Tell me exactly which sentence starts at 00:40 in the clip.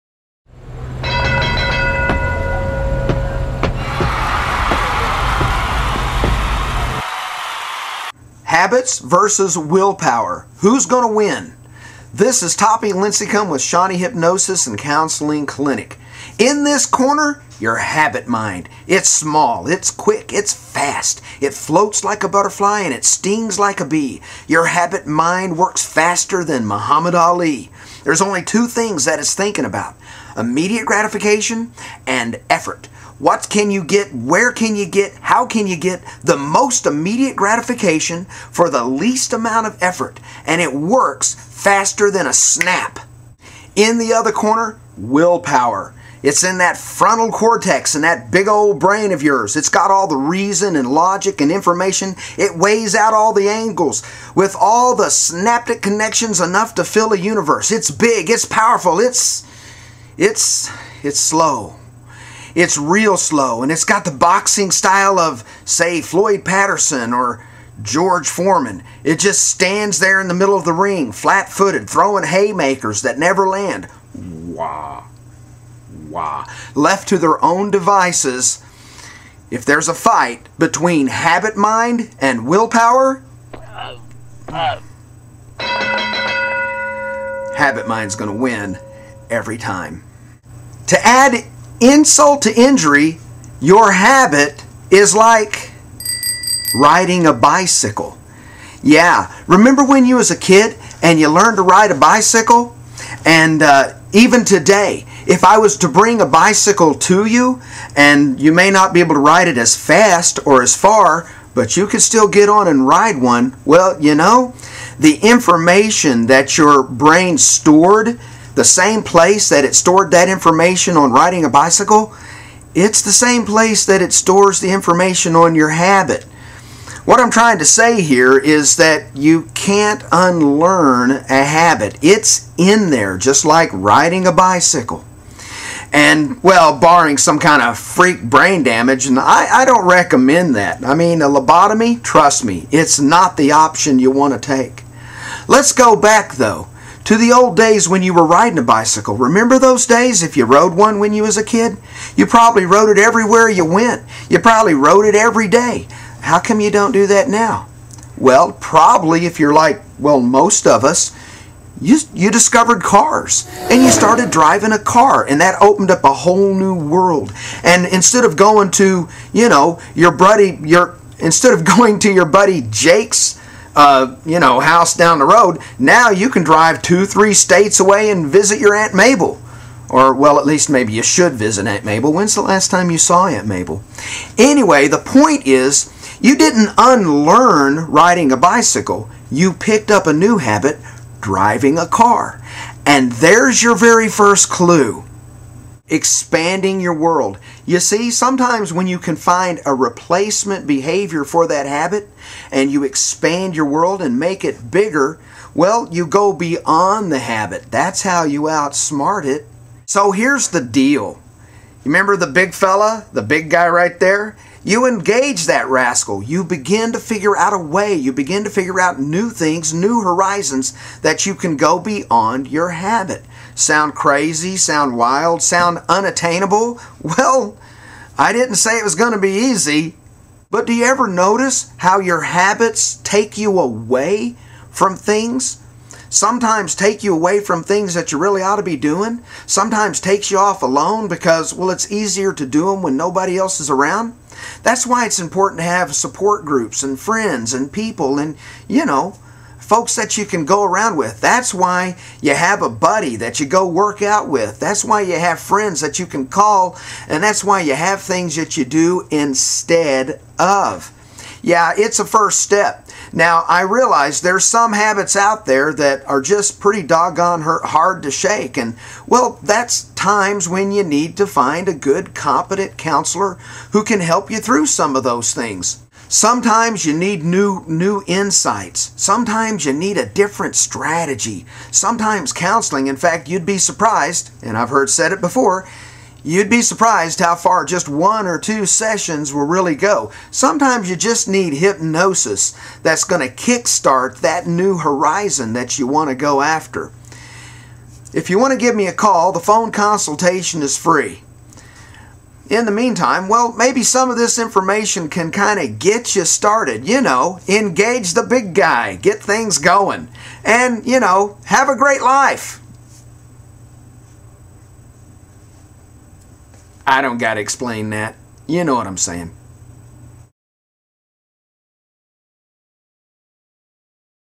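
And it works faster than a snap.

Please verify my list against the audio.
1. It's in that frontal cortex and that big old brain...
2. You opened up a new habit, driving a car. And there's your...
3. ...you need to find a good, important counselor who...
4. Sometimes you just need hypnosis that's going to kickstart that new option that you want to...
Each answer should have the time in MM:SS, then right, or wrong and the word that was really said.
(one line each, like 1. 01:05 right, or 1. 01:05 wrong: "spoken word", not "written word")
1. 00:46 right
2. 03:09 wrong: "picked", not "opened"
3. 04:30 wrong: "competent", not "important"
4. 04:50 wrong: "horizon", not "option".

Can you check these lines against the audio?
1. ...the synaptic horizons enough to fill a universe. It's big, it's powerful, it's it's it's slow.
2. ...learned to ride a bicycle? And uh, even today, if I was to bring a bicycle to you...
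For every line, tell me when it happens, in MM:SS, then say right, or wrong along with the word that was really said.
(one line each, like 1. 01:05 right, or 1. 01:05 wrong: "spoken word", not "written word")
1. 00:54 wrong: "connections", not "horizons"
2. 01:41 right.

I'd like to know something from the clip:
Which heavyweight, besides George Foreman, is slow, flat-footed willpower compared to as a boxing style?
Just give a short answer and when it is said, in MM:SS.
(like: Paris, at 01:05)
Floyd Patterson, at 01:06.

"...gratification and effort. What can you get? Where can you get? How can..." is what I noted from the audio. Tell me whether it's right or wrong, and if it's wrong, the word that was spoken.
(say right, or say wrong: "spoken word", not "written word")
right.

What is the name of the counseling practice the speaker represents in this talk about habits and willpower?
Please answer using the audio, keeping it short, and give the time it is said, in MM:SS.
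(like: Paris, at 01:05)
Shawnee Hypnosis and Counseling Clinic, at 00:13.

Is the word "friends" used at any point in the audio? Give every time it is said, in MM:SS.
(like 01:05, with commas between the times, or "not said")
04:06, 04:15.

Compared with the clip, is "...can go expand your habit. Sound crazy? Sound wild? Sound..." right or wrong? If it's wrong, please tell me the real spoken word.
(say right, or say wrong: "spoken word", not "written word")
wrong: "beyond", not "expand".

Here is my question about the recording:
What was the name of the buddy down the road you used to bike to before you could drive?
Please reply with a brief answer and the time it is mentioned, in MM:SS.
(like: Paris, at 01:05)
Jake, at 02:52.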